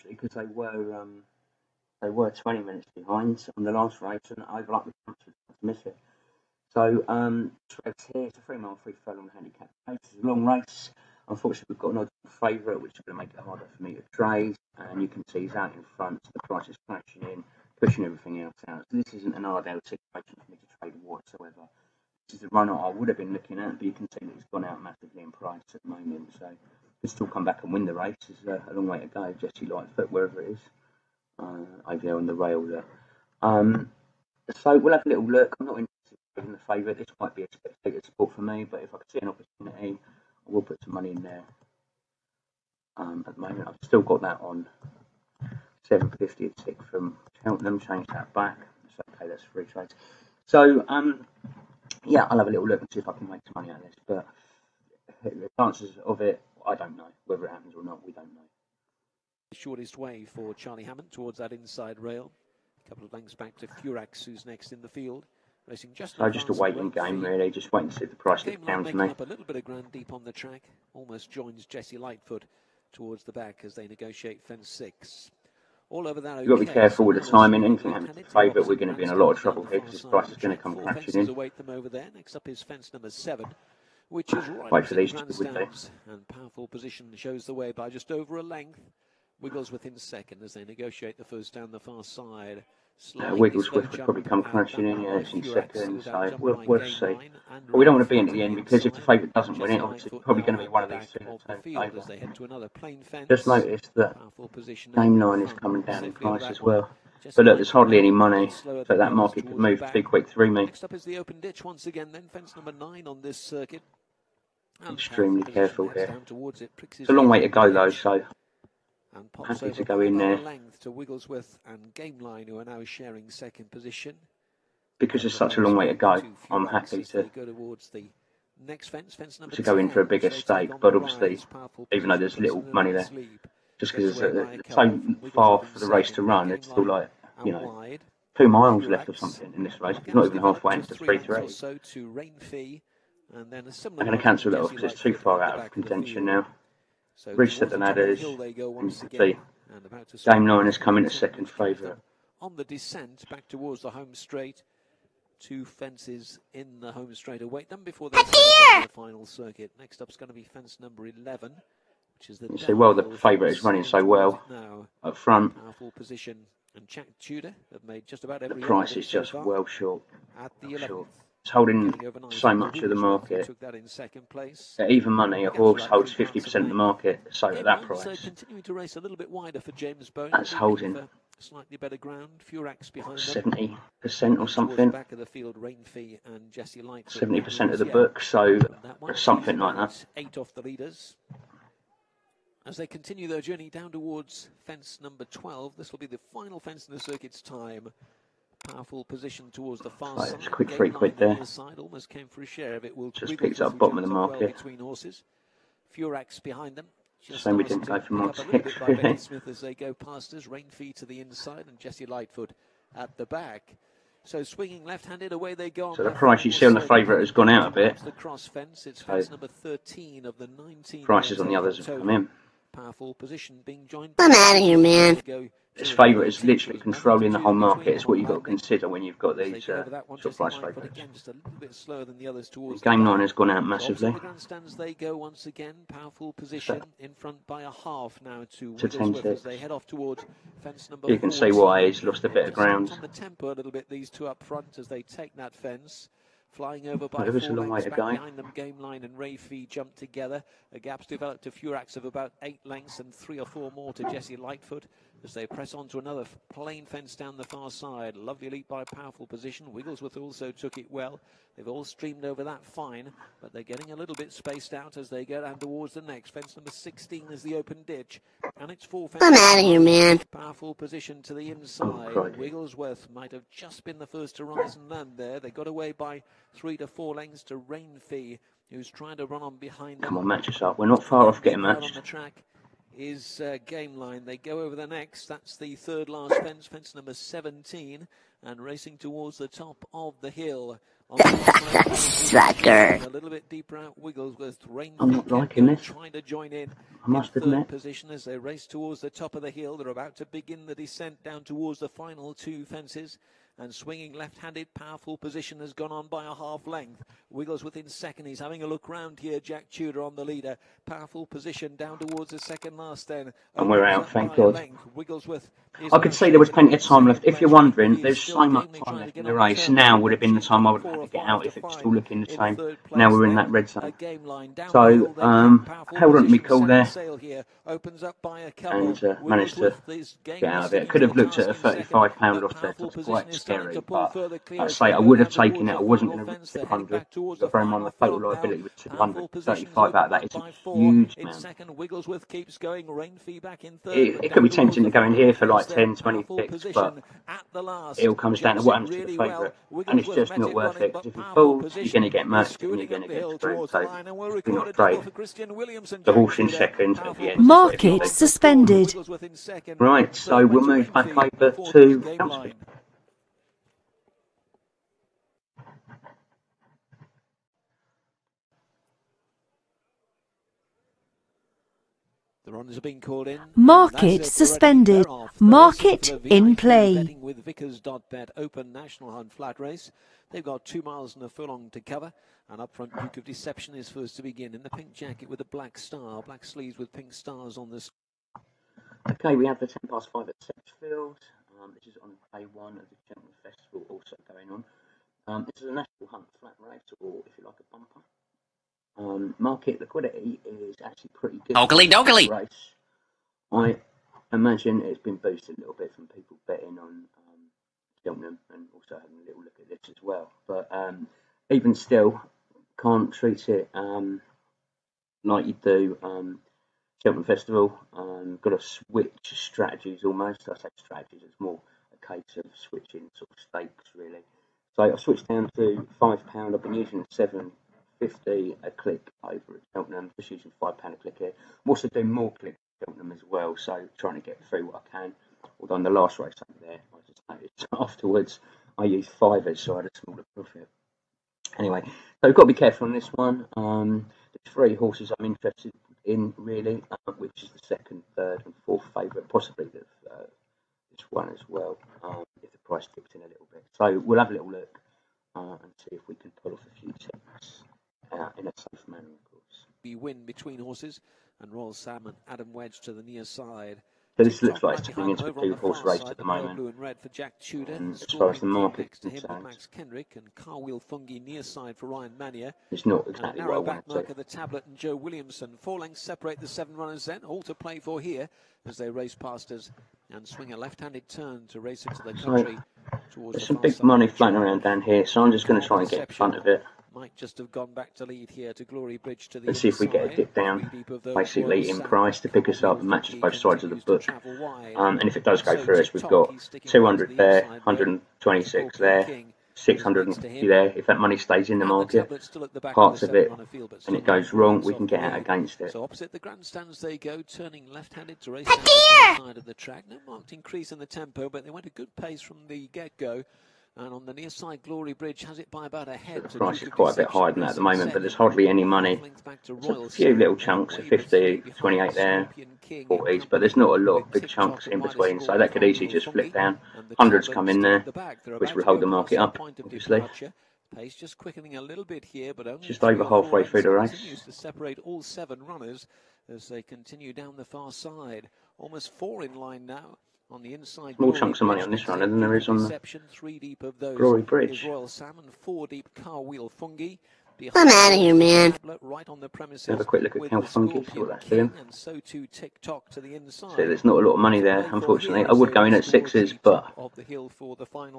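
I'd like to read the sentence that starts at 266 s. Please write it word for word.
Fence number 16 is the open ditch, and it's four fences.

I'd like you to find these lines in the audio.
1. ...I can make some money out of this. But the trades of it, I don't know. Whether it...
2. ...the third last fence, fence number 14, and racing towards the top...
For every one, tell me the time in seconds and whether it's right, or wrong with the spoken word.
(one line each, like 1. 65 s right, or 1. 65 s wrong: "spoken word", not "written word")
1. 53 s wrong: "chances", not "trades"
2. 285 s wrong: "17", not "14".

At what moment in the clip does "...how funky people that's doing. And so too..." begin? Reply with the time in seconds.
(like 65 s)
550 s.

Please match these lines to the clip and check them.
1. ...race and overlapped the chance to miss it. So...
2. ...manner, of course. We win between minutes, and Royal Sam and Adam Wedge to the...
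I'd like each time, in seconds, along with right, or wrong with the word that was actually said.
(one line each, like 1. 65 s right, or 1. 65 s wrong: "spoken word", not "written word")
1. 4 s right
2. 458 s wrong: "horses", not "minutes".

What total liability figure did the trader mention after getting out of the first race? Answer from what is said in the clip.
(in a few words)
235.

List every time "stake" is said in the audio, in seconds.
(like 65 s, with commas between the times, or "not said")
130 s, 423 s.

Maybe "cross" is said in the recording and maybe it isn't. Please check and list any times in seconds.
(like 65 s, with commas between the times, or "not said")
218 s.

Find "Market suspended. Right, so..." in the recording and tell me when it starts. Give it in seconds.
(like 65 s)
357 s.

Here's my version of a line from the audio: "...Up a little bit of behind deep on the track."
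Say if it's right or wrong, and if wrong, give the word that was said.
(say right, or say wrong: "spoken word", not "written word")
wrong: "ground", not "behind".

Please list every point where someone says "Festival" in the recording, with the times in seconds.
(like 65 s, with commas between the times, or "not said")
393 s, 417 s.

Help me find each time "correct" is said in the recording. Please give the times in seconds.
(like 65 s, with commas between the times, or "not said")
not said.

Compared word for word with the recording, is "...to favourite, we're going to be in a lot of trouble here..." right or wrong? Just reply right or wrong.
right.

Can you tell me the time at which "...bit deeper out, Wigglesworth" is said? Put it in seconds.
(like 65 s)
293 s.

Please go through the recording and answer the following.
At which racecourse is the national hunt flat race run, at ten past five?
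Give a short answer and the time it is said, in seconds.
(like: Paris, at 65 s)
Sedgefield, at 390 s.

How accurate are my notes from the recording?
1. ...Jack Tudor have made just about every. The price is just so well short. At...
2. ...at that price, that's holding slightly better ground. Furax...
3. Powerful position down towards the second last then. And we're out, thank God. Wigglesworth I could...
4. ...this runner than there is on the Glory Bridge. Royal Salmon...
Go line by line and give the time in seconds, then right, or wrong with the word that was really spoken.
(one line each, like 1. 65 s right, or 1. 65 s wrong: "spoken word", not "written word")
1. 166 s right
2. 177 s right
3. 310 s right
4. 541 s right.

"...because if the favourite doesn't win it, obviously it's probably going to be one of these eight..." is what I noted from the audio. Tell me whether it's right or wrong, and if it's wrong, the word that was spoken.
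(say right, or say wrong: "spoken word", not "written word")
wrong: "two", not "eight".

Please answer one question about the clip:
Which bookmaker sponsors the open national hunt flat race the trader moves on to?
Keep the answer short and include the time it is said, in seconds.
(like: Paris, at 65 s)
Vickers.bet, at 377 s.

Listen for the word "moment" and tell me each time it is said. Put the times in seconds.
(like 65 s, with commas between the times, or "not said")
25 s, 43 s, 466 s, 517 s.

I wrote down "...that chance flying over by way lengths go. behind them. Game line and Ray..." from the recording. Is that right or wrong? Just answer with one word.
wrong.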